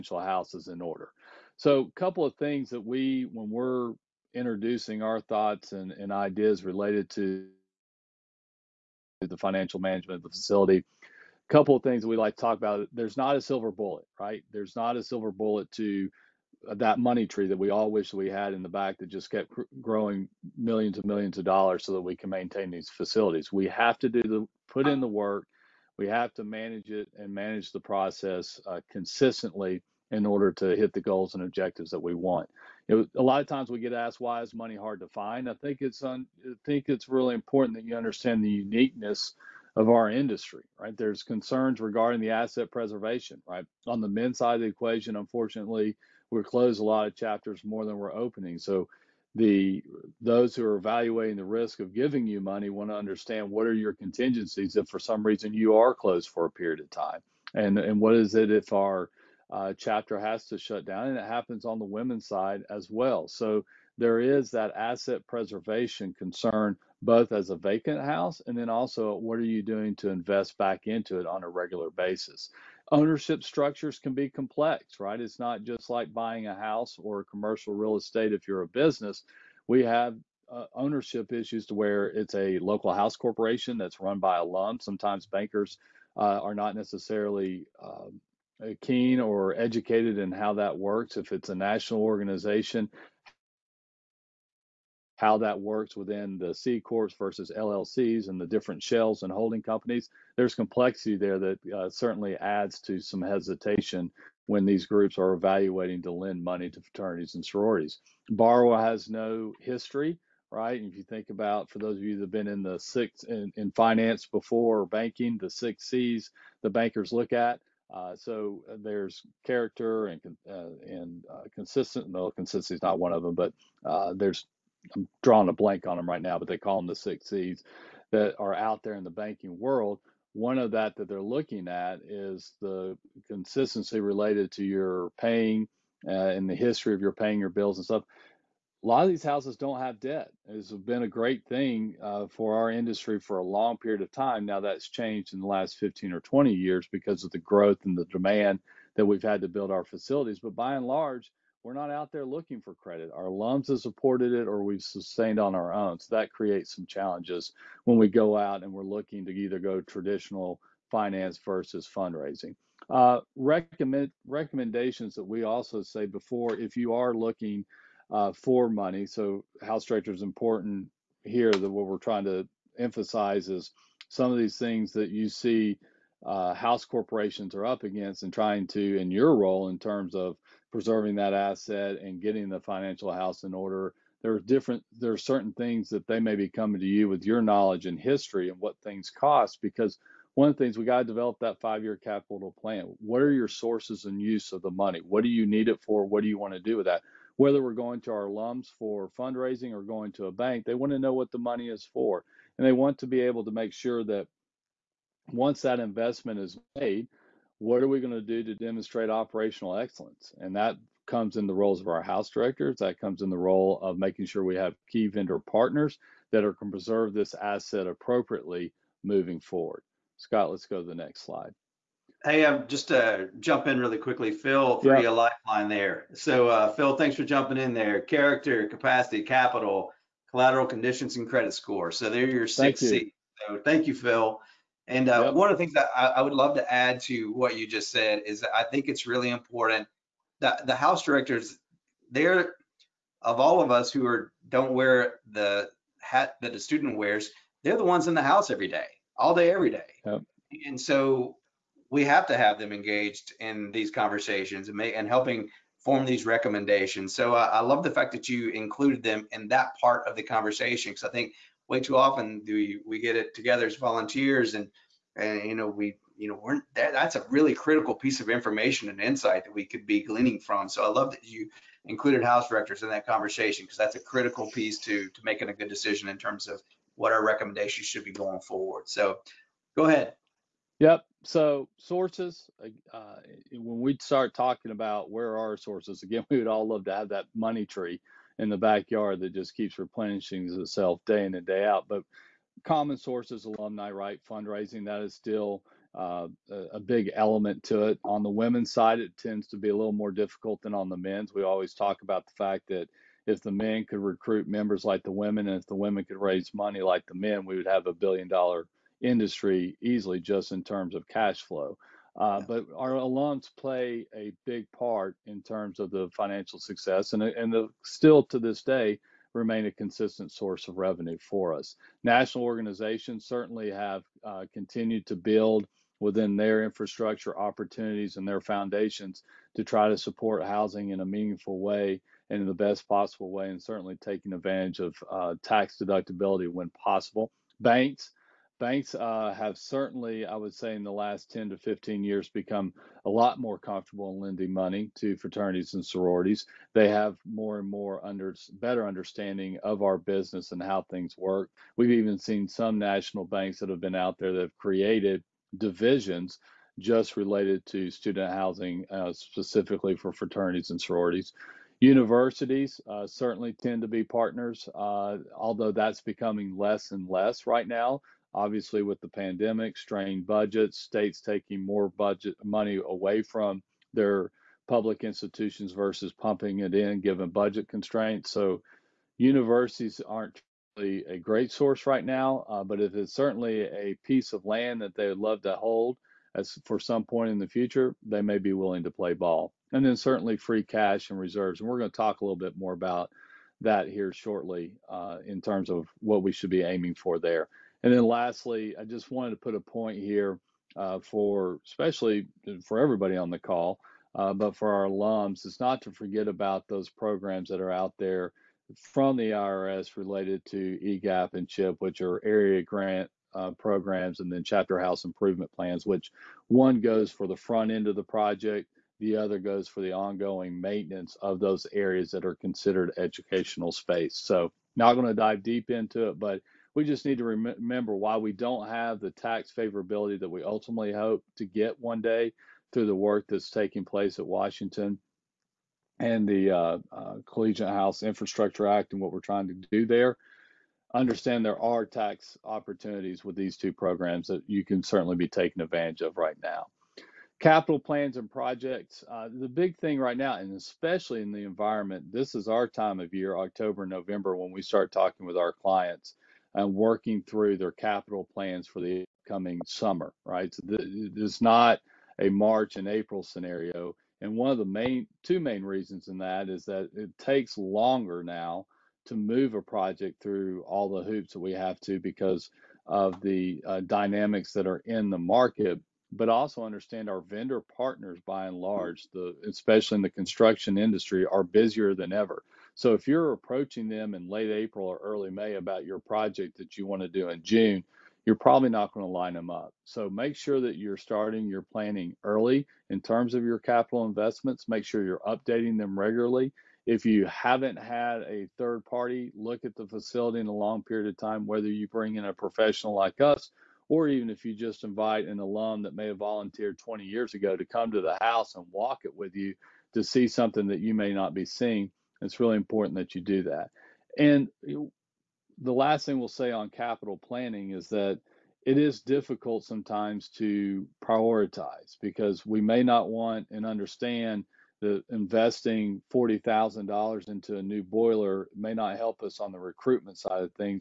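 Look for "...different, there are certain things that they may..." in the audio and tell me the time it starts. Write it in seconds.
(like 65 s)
184 s.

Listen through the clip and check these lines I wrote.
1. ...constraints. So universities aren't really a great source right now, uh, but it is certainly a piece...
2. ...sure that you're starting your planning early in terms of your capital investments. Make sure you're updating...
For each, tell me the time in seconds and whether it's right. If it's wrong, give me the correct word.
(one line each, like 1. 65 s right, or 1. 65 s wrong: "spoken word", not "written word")
1. 377 s right
2. 490 s right.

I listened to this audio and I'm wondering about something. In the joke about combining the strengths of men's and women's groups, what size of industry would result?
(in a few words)
billion dollar.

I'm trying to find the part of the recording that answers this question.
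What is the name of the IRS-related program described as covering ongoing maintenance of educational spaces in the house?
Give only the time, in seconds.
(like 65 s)
414 s.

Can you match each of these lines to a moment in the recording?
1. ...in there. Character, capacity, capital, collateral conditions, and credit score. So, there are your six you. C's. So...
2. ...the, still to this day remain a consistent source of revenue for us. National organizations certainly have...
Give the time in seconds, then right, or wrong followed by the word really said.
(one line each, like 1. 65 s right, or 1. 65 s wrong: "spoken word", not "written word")
1. 227 s right
2. 317 s right.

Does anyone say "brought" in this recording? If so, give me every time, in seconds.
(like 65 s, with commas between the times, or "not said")
not said.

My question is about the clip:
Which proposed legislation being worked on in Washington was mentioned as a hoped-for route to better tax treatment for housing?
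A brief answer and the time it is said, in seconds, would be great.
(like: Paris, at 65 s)
Collegiate House Infrastructure Act, at 437 s.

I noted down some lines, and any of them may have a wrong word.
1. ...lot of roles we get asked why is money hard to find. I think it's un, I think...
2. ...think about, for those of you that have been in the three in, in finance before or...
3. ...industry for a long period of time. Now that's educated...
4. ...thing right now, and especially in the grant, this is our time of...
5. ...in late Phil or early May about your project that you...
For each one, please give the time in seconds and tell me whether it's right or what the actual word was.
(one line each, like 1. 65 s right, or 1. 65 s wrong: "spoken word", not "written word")
1. 33 s wrong: "times", not "roles"
2. 111 s wrong: "six", not "three"
3. 142 s wrong: "changed", not "educated"
4. 449 s wrong: "environment", not "grant"
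5. 484 s wrong: "April", not "Phil".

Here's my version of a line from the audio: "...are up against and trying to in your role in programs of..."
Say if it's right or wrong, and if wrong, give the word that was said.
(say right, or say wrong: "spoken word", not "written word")
wrong: "terms", not "programs".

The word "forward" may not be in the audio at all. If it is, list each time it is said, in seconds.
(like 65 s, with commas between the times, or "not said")
219 s, 278 s.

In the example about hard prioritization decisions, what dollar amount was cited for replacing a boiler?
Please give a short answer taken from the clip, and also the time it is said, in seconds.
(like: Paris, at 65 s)
$40,000, at 526 s.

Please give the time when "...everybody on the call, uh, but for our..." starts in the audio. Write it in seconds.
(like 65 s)
402 s.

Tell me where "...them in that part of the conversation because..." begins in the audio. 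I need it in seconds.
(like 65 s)
259 s.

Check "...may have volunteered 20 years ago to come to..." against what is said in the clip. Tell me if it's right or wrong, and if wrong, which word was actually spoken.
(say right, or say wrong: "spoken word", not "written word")
right.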